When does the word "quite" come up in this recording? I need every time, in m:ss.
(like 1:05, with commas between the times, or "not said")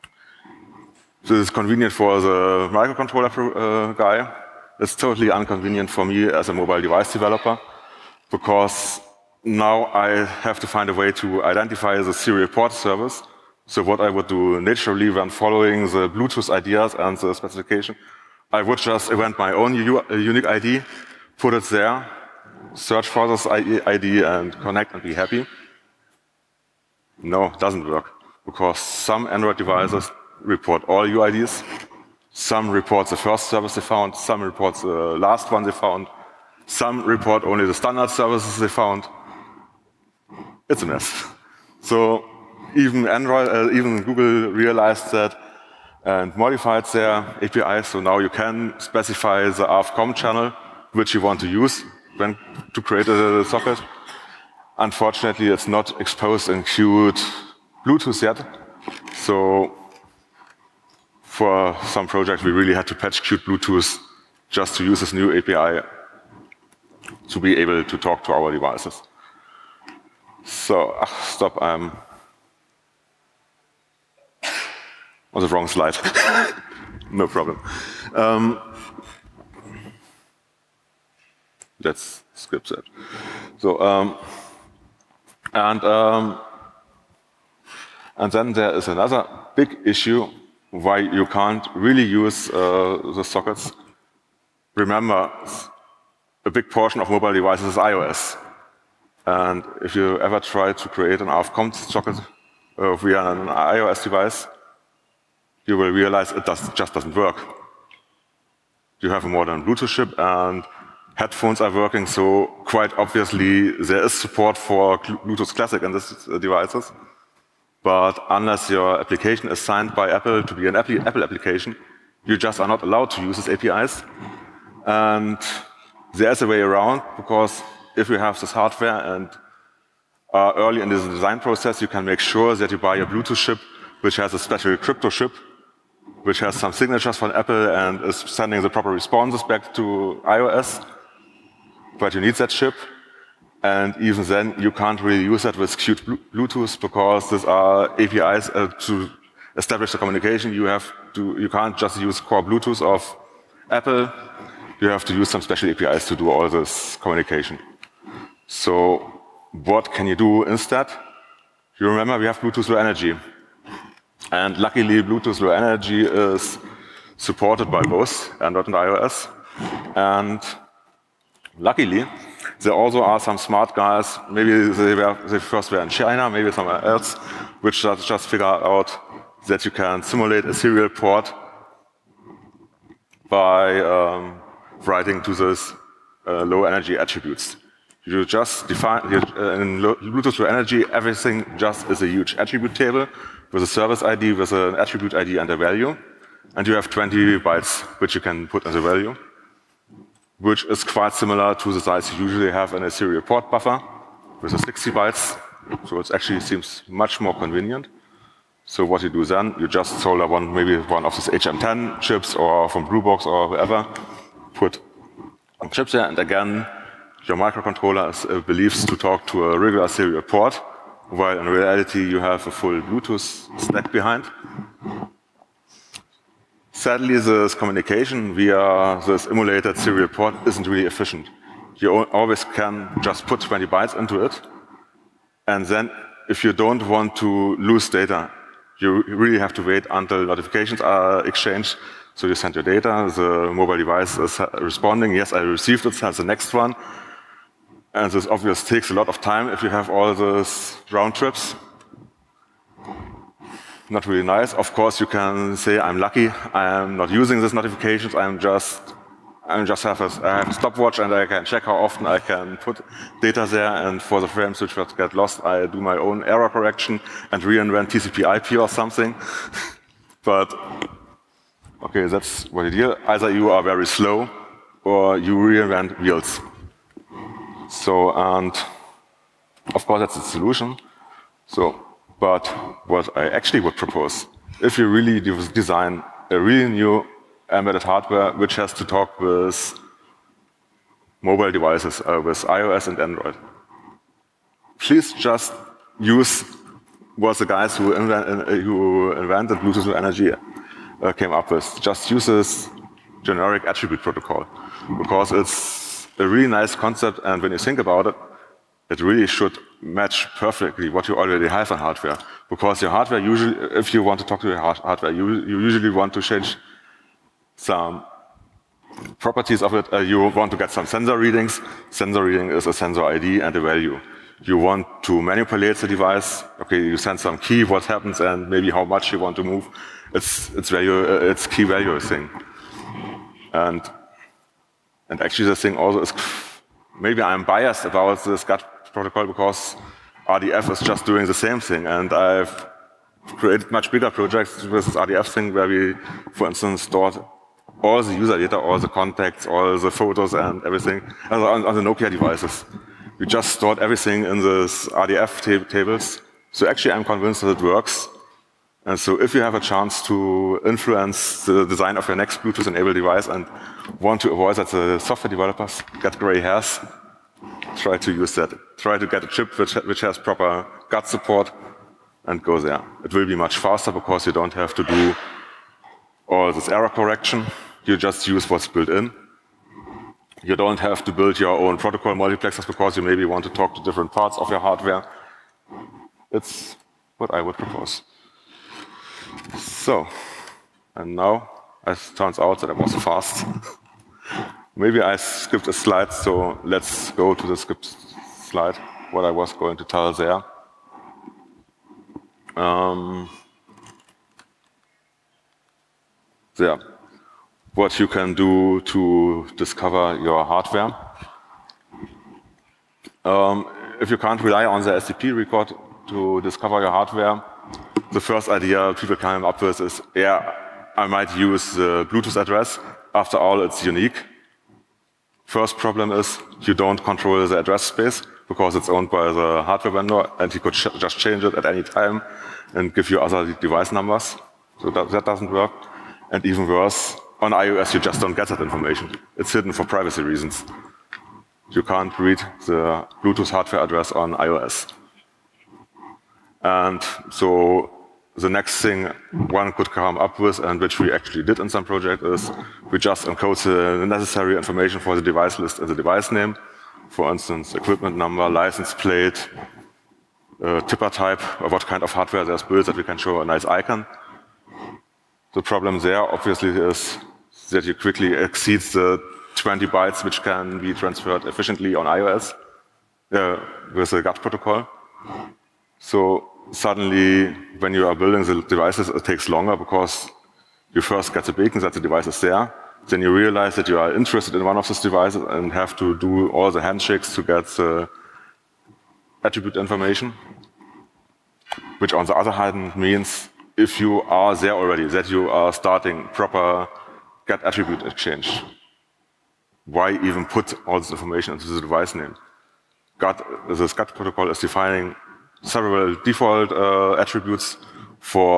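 1:52, 3:20.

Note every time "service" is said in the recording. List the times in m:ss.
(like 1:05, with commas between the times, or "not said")
0:12, 0:33, 0:38, 3:13.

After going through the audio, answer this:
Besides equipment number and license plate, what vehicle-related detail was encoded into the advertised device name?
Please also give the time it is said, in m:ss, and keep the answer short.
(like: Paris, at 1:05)
tipper type, at 7:40.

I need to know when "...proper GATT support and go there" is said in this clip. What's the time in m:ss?
6:10.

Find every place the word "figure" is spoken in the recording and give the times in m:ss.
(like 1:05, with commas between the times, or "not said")
2:58.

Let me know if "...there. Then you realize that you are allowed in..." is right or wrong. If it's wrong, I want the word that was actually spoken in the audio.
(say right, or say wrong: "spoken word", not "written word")
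wrong: "interested", not "allowed".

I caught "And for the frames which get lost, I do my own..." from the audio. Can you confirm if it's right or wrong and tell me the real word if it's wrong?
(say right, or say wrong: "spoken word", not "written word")
right.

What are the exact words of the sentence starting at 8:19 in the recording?
Why even put all this information into the device name?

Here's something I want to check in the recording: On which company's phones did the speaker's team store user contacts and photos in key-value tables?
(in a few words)
Nokia.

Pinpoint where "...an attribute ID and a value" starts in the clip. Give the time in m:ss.
3:14.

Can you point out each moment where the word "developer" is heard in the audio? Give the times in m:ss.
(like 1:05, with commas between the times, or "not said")
0:07, 6:05.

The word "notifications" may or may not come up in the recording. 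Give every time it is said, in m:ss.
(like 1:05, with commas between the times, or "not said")
4:00, 4:17.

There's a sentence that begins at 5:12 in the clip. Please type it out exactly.
Because your hardware usually, if you want to talk to your hardware, you, you usually want to change some properties of it.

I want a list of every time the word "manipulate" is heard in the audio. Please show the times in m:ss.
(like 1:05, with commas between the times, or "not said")
5:25.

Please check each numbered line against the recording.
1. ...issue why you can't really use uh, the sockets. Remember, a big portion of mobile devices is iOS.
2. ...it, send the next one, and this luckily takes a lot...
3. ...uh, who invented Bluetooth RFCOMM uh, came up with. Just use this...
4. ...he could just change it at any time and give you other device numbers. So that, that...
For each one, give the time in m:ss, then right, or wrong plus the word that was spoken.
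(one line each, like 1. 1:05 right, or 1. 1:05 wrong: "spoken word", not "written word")
1. 1:29 right
2. 4:05 wrong: "obviously", not "luckily"
3. 4:58 wrong: "Energy", not "RFCOMM"
4. 7:10 right.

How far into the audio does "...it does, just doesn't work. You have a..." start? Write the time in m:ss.
1:46.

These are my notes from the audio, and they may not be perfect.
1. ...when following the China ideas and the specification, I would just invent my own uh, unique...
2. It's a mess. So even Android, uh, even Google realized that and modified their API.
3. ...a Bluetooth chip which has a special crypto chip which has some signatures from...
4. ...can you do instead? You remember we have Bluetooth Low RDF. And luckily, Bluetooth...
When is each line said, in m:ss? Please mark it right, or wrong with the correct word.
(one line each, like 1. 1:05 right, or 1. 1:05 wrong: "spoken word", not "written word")
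1. 0:15 wrong: "Bluetooth", not "China"
2. 0:40 right
3. 2:12 right
4. 2:39 wrong: "Energy", not "RDF".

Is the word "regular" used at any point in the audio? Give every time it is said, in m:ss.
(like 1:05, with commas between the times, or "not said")
3:39.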